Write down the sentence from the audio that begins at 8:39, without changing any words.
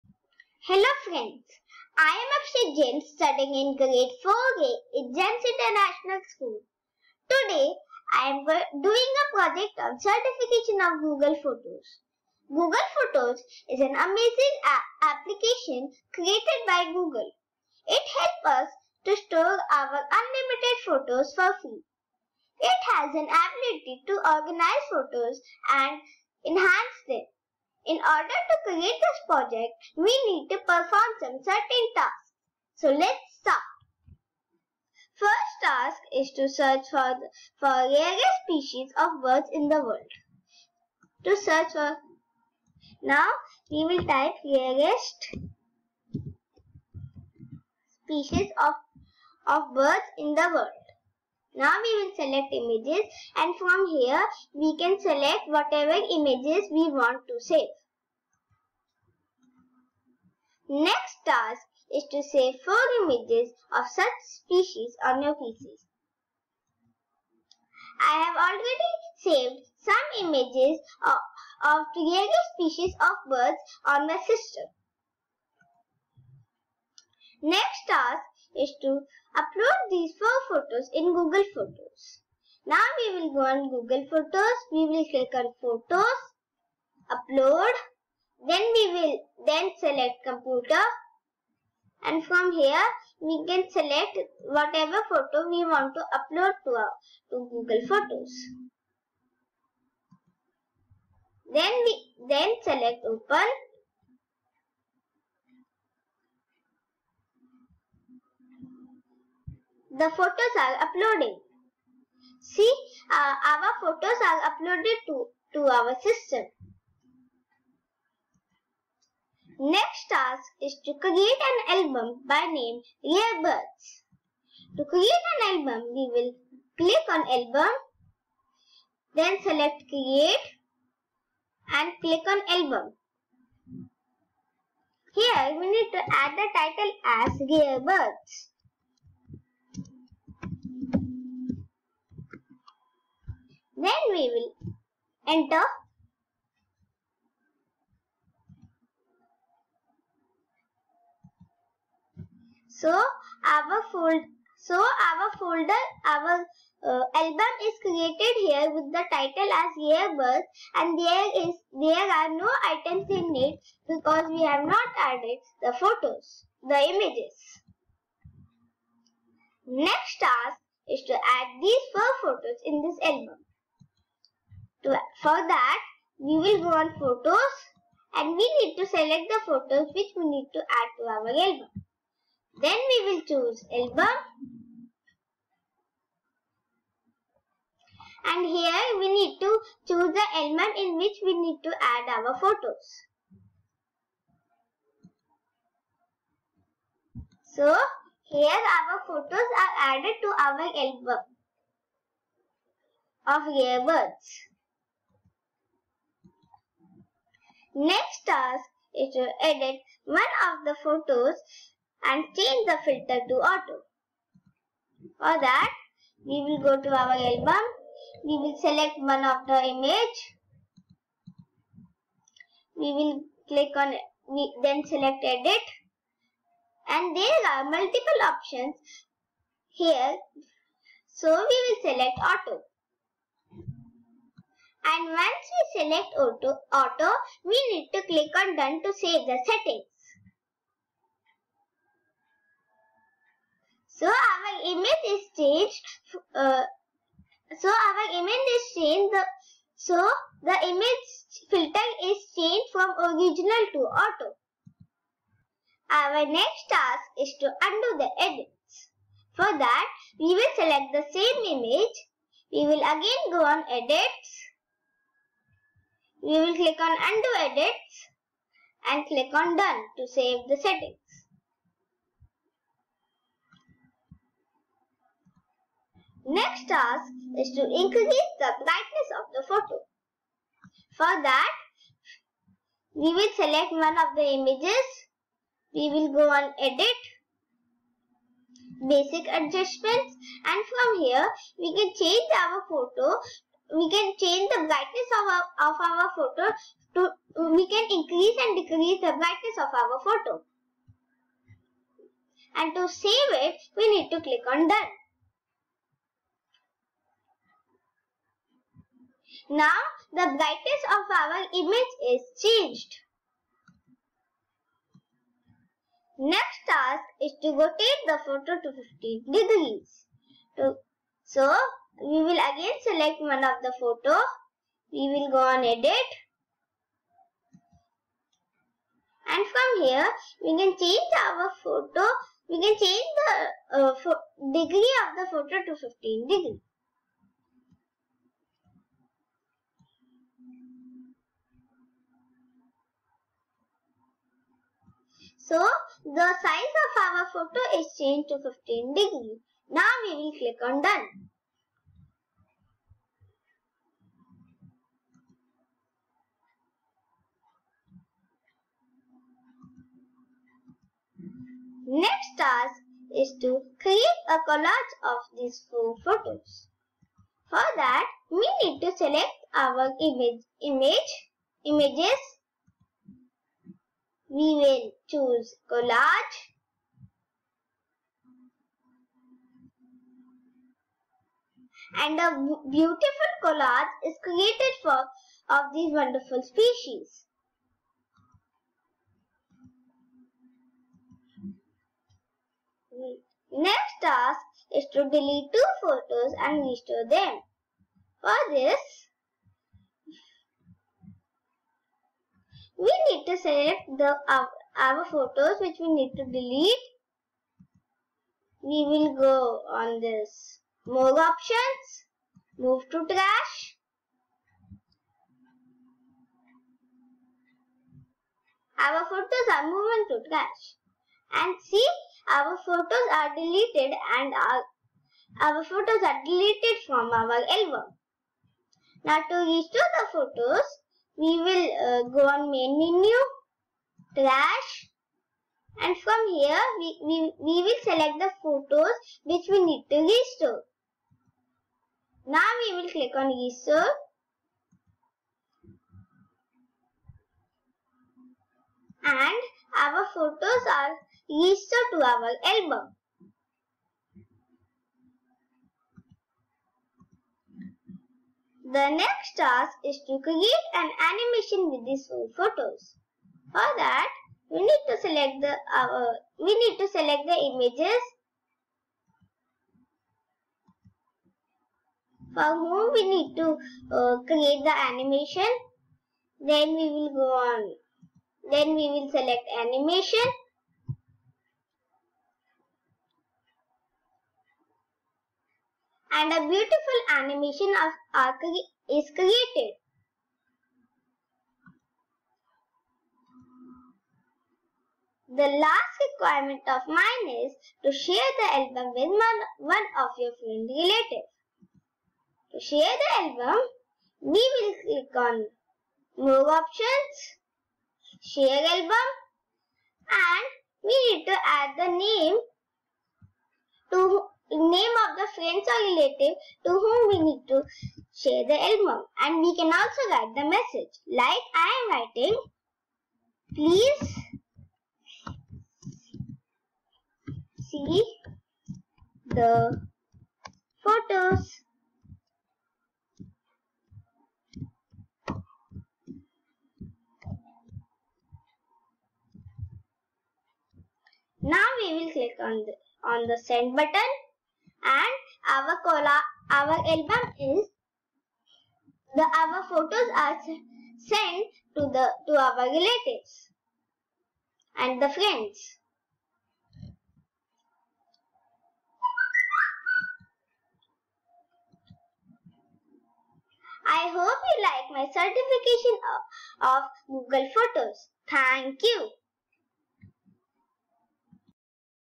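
And we can also write the message.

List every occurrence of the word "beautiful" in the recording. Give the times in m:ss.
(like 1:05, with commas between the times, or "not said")
6:22, 8:06.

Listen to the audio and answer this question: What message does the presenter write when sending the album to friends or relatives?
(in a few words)
Please see the photos.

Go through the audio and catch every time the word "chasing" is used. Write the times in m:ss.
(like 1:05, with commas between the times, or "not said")
not said.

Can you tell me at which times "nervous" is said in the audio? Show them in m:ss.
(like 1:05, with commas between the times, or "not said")
not said.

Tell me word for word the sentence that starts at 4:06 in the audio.
Uh, so our image is changed.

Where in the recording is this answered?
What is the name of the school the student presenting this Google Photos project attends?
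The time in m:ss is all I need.
0:05.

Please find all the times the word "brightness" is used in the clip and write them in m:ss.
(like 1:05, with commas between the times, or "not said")
4:38, 4:54, 4:59, 5:10.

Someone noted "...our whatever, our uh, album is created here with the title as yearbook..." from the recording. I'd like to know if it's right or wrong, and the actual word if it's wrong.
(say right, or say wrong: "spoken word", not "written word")
wrong: "folder", not "whatever".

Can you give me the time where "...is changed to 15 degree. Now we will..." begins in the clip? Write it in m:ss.
5:47.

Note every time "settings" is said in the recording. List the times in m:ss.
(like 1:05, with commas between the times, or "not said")
3:59, 4:30.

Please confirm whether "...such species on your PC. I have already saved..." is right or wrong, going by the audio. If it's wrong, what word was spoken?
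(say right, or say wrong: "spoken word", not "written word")
right.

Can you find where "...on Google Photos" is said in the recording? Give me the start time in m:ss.
1:23.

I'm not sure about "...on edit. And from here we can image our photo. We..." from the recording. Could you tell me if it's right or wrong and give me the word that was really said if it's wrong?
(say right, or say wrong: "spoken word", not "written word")
wrong: "change", not "image".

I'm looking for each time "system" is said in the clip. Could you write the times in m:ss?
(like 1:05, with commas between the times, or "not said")
1:14, 1:56.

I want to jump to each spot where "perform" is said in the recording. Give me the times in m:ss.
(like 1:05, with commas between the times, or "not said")
0:30.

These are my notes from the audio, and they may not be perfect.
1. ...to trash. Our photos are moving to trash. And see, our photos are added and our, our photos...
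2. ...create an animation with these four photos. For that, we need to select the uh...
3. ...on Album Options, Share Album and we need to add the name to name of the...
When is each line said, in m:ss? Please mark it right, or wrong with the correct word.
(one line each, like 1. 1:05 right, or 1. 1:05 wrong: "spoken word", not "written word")
1. 6:52 wrong: "deleted", not "added"
2. 7:40 right
3. 8:25 wrong: "More", not "Album".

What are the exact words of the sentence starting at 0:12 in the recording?
Google Photos is an amazing application created by Google.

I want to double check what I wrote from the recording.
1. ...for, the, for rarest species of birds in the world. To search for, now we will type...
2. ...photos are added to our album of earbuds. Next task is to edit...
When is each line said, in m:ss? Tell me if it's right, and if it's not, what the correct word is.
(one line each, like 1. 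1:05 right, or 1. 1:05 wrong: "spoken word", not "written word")
1. 0:36 right
2. 3:19 right.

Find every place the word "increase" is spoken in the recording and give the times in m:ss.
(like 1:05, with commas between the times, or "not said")
4:37, 4:57.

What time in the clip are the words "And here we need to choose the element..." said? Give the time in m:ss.
3:08.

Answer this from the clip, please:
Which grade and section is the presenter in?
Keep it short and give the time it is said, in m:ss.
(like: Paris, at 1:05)
4A, at 0:03.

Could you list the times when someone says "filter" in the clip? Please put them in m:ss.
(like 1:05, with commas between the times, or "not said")
3:32, 4:11.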